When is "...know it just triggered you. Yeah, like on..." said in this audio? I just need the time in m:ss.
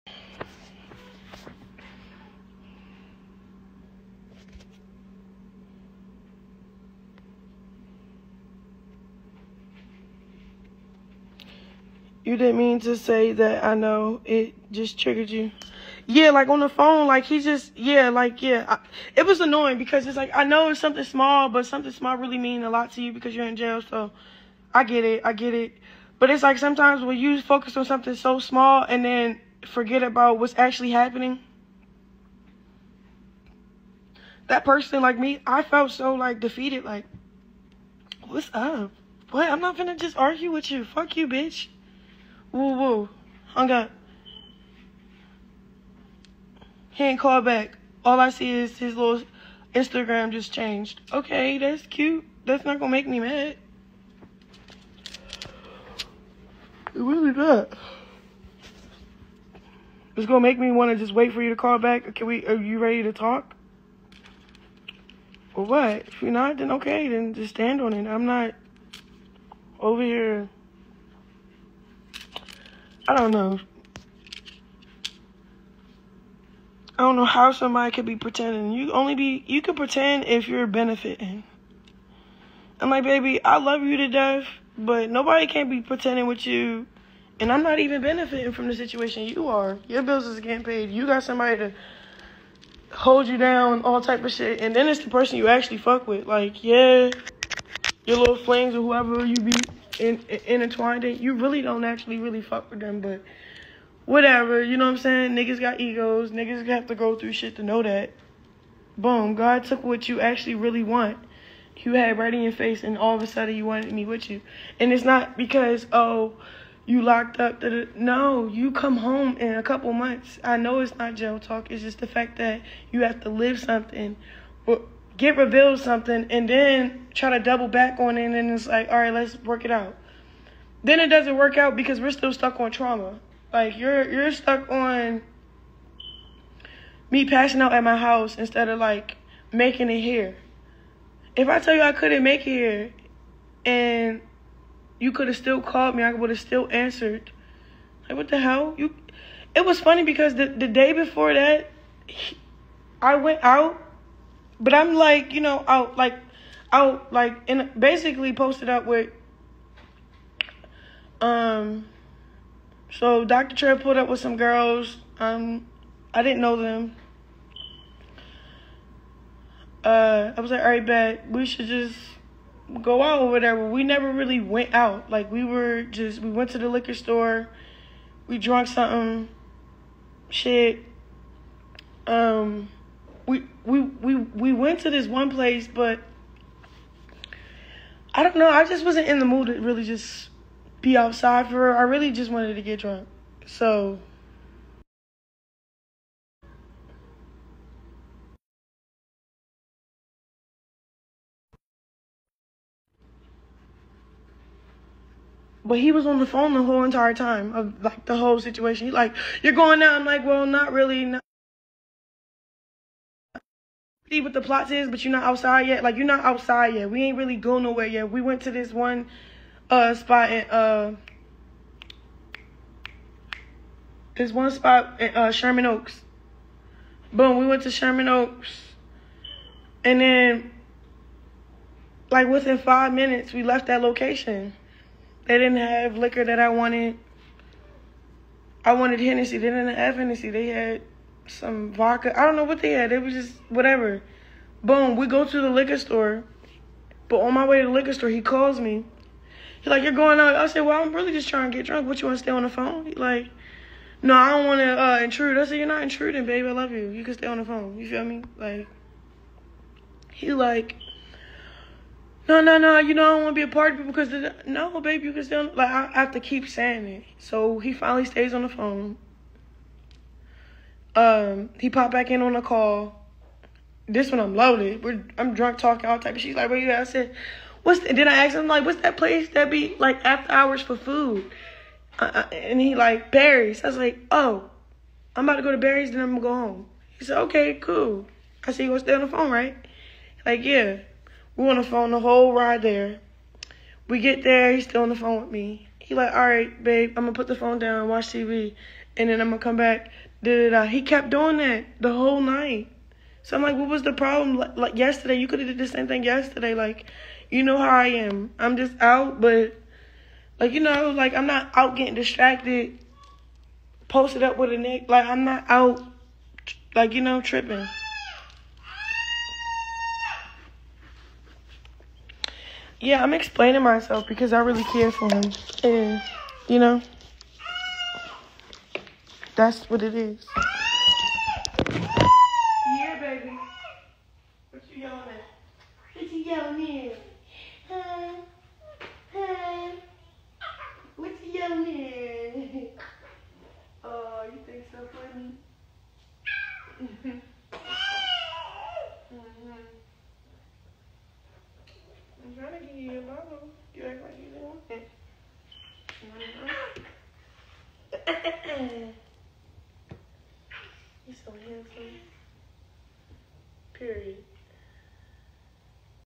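0:13.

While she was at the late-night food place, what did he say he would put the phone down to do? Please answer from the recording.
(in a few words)
watch TV.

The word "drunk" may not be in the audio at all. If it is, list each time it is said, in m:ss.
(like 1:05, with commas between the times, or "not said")
3:12, 4:11, 4:35.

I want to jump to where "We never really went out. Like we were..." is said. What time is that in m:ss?
2:53.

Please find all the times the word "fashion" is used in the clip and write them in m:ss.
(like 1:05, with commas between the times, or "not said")
not said.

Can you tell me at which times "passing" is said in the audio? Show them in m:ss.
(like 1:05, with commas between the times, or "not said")
2:17.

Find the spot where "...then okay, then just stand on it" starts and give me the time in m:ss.
1:06.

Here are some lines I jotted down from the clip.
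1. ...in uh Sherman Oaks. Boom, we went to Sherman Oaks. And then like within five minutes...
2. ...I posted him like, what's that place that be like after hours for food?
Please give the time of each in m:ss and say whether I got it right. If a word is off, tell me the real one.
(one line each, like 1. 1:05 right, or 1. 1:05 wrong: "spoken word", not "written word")
1. 3:44 right
2. 4:38 wrong: "asked", not "posted".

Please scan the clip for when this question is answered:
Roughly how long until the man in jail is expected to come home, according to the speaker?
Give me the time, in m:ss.
1:59.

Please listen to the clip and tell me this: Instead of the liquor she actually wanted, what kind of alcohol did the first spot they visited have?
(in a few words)
vodka.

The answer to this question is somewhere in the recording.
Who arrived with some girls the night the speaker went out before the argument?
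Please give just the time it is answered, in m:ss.
2:43.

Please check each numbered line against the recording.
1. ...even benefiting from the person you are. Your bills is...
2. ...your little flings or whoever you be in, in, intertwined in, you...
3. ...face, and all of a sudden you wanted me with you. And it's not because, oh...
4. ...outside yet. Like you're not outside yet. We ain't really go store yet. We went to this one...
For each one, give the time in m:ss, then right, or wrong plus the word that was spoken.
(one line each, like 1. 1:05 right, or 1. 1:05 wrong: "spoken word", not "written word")
1. 1:27 wrong: "situation", not "person"
2. 1:38 right
3. 1:52 right
4. 3:35 wrong: "nowhere", not "store".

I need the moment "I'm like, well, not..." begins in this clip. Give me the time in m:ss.
3:29.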